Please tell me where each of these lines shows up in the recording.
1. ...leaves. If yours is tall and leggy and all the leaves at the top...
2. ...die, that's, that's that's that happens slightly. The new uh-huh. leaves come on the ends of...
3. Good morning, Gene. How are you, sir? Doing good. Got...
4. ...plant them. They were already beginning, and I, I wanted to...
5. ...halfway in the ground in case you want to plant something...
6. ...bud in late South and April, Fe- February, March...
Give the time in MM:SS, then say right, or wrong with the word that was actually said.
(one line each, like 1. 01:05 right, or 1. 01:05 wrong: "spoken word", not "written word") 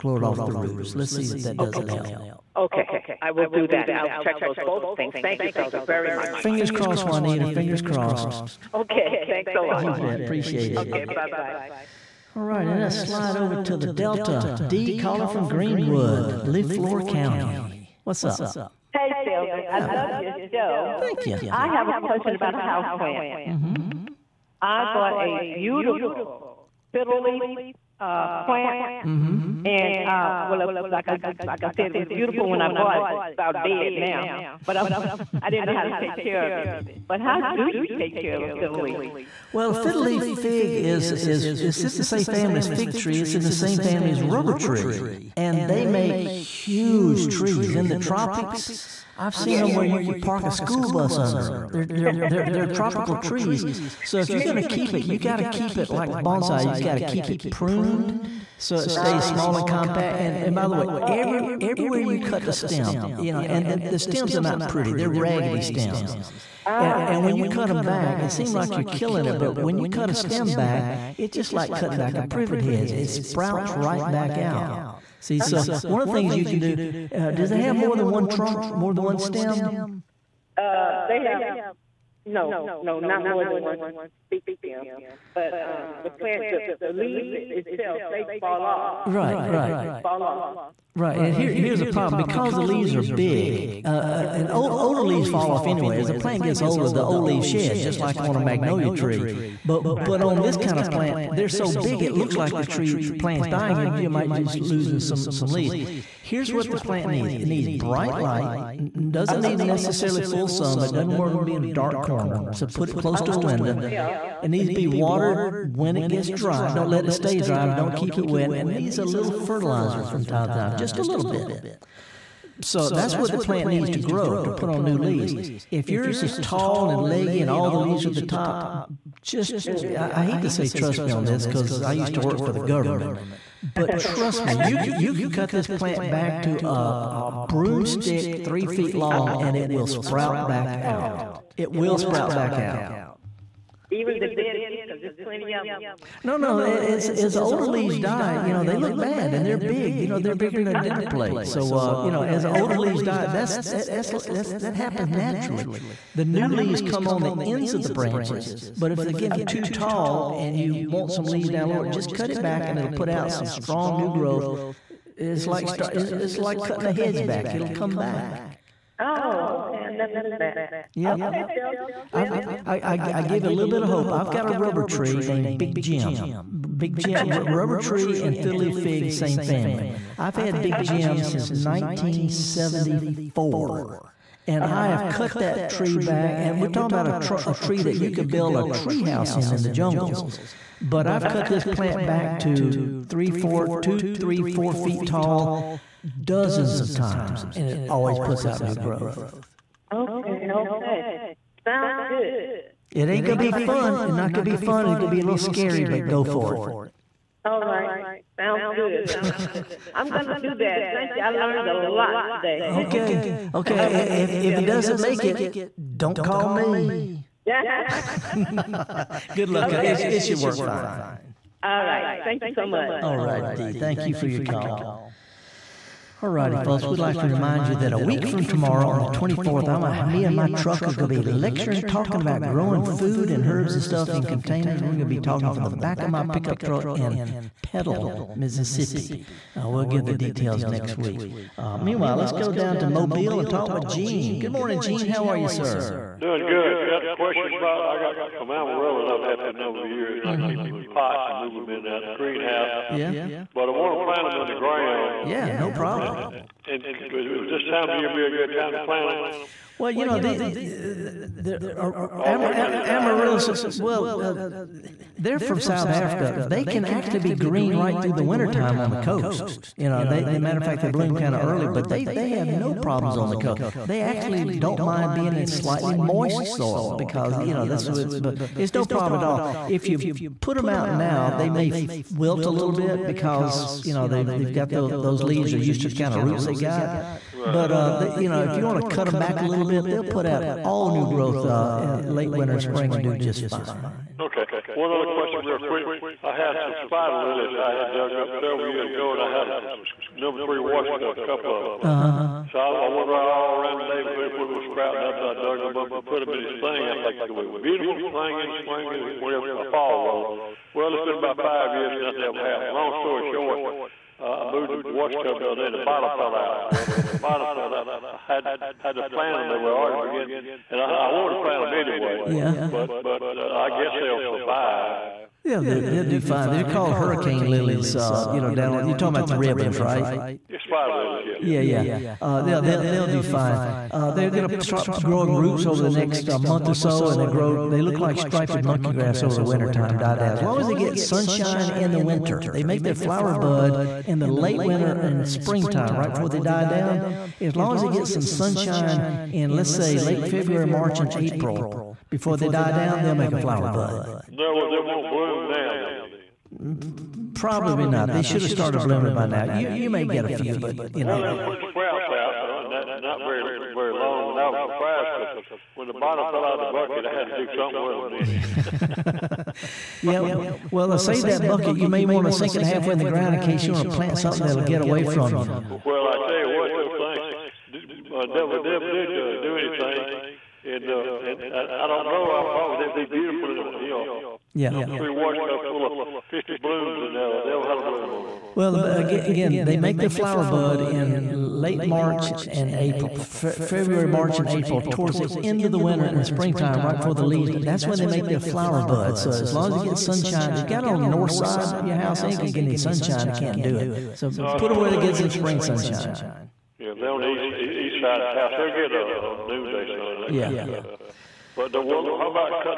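1. 02:04 right
2. 02:33 wrong: "naturally", not "slightly"
3. 04:04 right
4. 05:19 right
5. 06:12 right
6. 06:30 wrong: "March", not "South".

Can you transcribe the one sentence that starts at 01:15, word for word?
so one of the things you can do, uh, does it have more than one trunk, more than one stem?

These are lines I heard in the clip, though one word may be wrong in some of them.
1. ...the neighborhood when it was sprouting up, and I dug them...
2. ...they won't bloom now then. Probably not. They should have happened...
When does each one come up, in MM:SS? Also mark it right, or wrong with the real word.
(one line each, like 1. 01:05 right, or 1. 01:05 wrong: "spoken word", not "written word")
1. 05:03 right
2. 05:54 wrong: "started", not "happened".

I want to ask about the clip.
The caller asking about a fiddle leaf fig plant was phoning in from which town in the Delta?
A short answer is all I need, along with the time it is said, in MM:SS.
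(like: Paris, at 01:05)
Greenwood, at 00:15.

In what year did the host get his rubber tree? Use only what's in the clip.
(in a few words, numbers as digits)
1974.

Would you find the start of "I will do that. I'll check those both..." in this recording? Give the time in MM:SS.
00:03.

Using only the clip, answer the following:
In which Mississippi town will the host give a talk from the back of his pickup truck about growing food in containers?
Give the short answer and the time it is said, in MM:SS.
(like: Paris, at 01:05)
Petal, at 03:57.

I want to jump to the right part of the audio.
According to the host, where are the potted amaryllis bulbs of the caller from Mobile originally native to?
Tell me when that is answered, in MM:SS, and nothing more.
04:25.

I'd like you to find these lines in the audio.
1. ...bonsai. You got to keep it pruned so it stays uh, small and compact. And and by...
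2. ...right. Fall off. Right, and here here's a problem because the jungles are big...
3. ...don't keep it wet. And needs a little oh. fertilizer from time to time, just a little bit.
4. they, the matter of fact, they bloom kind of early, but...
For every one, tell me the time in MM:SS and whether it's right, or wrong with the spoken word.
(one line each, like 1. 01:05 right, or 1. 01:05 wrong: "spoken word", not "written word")
1. 00:56 right
2. 01:29 wrong: "leaves", not "jungles"
3. 01:57 right
4. 04:30 right.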